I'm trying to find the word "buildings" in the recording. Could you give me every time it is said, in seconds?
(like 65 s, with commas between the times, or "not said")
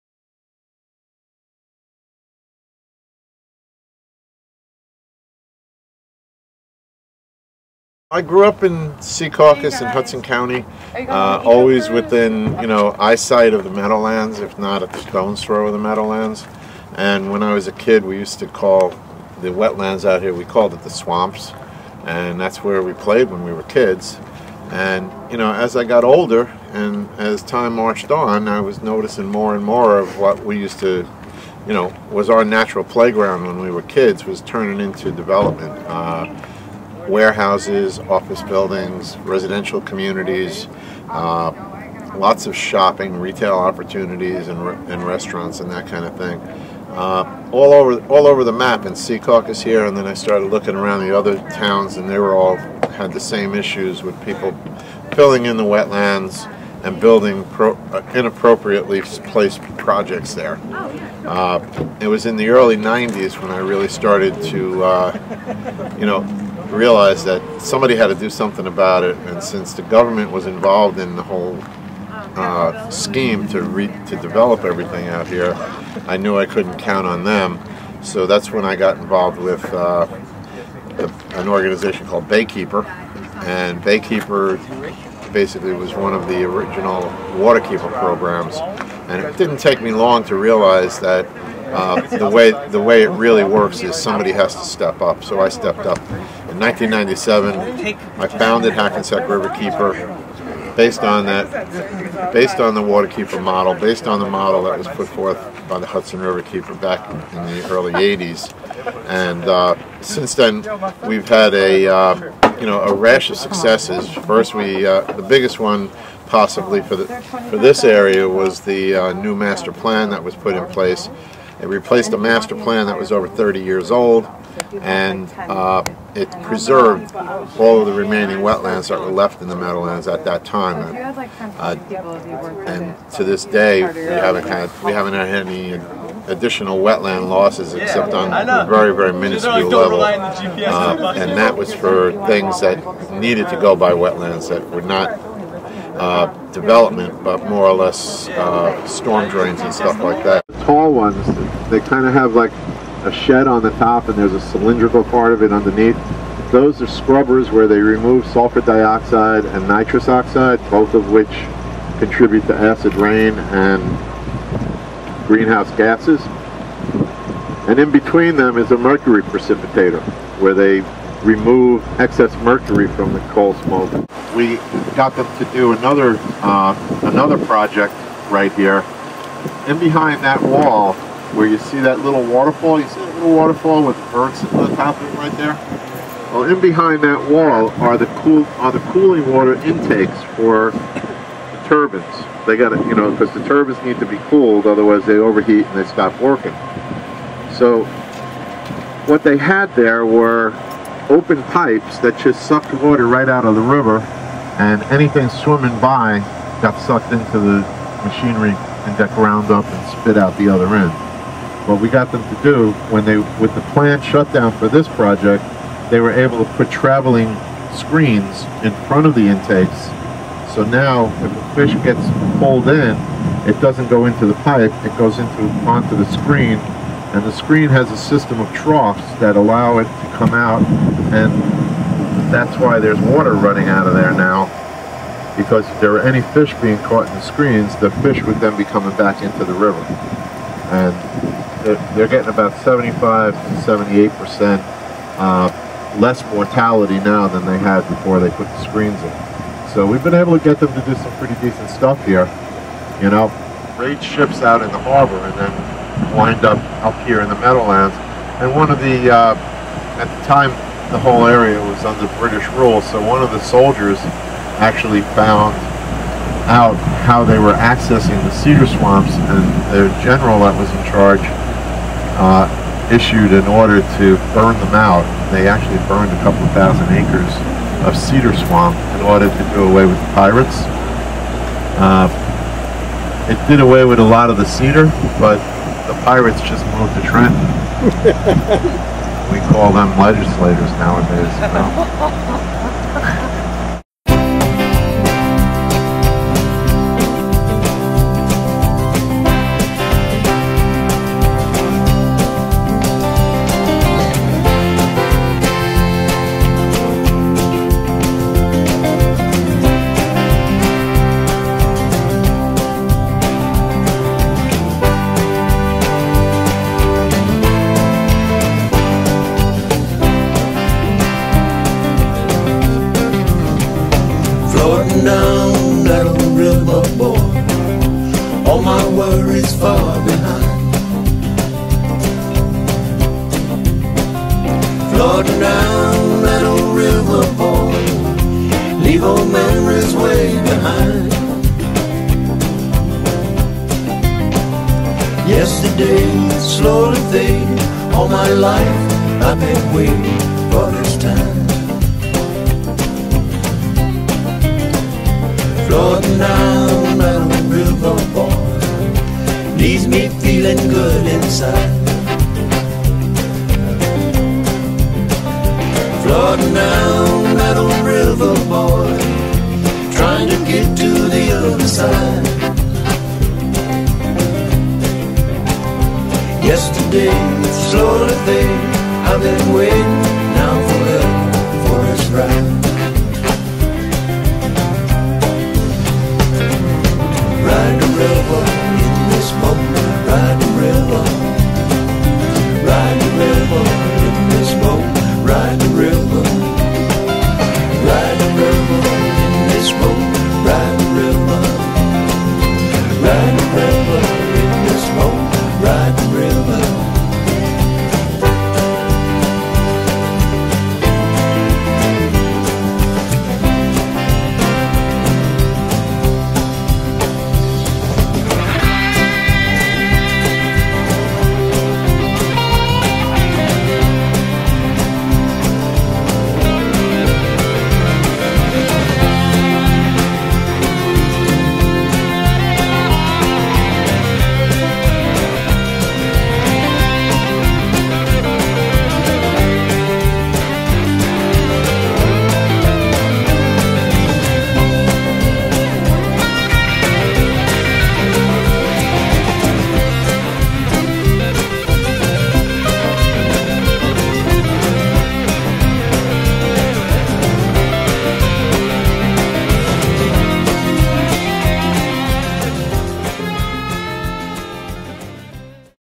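38 s, 56 s.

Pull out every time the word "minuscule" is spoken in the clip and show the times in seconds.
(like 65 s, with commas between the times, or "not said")
139 s.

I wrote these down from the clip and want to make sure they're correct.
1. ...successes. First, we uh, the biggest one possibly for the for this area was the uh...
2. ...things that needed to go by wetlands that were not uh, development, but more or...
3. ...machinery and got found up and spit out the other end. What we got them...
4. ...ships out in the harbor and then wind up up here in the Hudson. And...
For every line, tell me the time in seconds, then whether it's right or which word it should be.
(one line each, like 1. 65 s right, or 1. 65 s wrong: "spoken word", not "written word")
1. 113 s right
2. 142 s right
3. 208 s wrong: "ground", not "found"
4. 254 s wrong: "Meadowlands", not "Hudson".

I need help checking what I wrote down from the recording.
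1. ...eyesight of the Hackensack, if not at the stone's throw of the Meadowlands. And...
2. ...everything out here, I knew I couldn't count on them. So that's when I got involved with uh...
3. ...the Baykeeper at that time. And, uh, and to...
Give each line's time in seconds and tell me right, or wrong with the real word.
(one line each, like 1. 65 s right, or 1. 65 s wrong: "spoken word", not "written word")
1. 12 s wrong: "Meadowlands", not "Hackensack"
2. 74 s right
3. 129 s wrong: "Meadowlands", not "Baykeeper".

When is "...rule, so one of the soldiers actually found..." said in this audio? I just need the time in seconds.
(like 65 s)
262 s.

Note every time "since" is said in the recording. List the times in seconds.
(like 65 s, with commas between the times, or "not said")
69 s, 110 s.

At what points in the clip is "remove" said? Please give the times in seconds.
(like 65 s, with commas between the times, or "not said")
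157 s, 171 s.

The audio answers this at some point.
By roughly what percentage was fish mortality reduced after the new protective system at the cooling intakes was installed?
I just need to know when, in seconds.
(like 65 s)
242 s.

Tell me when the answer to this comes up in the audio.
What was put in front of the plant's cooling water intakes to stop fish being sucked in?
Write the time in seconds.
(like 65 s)
216 s.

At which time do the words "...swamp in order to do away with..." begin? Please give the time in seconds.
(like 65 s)
278 s.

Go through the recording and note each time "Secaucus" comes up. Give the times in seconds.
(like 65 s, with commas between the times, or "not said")
8 s, 48 s.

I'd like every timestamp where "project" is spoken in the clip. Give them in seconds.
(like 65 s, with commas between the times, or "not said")
59 s, 177 s, 214 s.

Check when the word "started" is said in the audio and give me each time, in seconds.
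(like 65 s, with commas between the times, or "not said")
50 s, 63 s.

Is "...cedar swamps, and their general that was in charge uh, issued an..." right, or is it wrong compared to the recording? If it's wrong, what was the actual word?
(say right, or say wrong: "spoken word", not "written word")
right.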